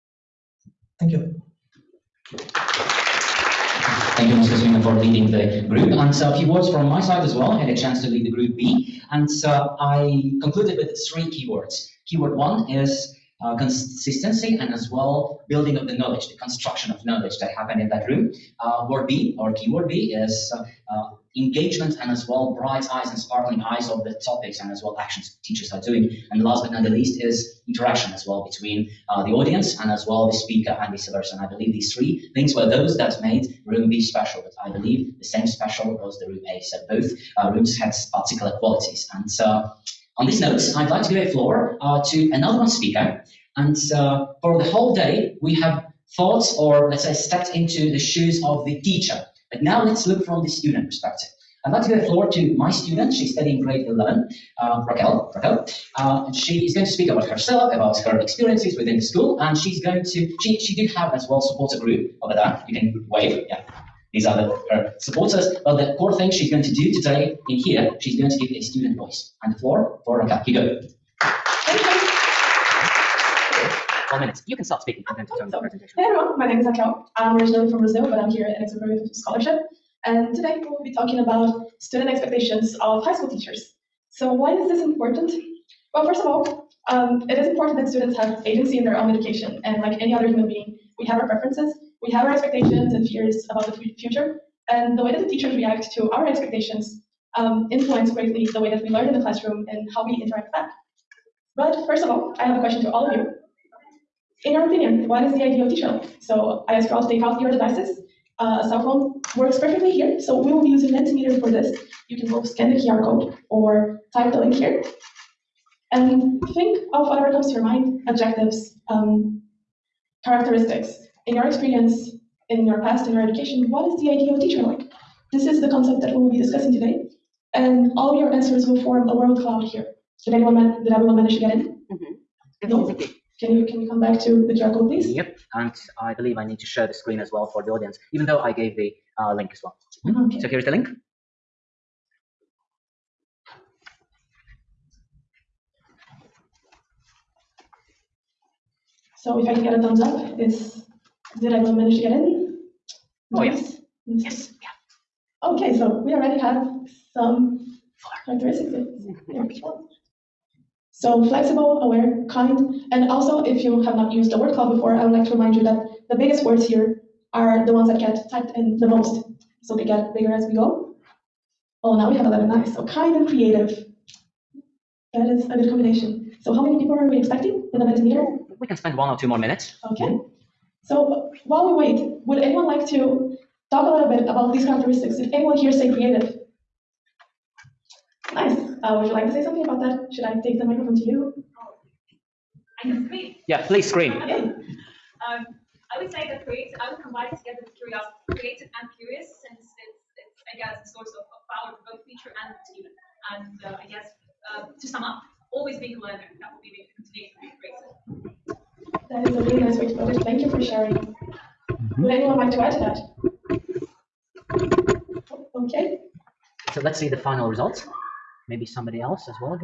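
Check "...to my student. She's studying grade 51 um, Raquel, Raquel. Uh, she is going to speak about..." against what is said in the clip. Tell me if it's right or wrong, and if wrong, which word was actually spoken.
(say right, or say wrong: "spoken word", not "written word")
wrong: "11", not "51".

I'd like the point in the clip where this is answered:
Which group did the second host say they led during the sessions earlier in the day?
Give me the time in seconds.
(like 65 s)
8 s.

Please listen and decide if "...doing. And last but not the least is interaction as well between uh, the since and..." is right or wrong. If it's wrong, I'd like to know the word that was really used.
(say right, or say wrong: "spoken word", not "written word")
wrong: "audience", not "since".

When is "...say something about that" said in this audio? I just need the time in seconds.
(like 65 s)
189 s.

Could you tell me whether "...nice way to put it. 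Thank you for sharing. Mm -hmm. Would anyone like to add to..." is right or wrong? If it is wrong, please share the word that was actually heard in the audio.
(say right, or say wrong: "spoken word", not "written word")
right.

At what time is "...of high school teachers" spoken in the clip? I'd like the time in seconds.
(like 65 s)
82 s.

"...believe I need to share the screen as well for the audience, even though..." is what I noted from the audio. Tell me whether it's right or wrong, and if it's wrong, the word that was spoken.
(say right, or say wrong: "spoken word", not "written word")
right.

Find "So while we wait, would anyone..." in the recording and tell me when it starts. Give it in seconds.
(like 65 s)
180 s.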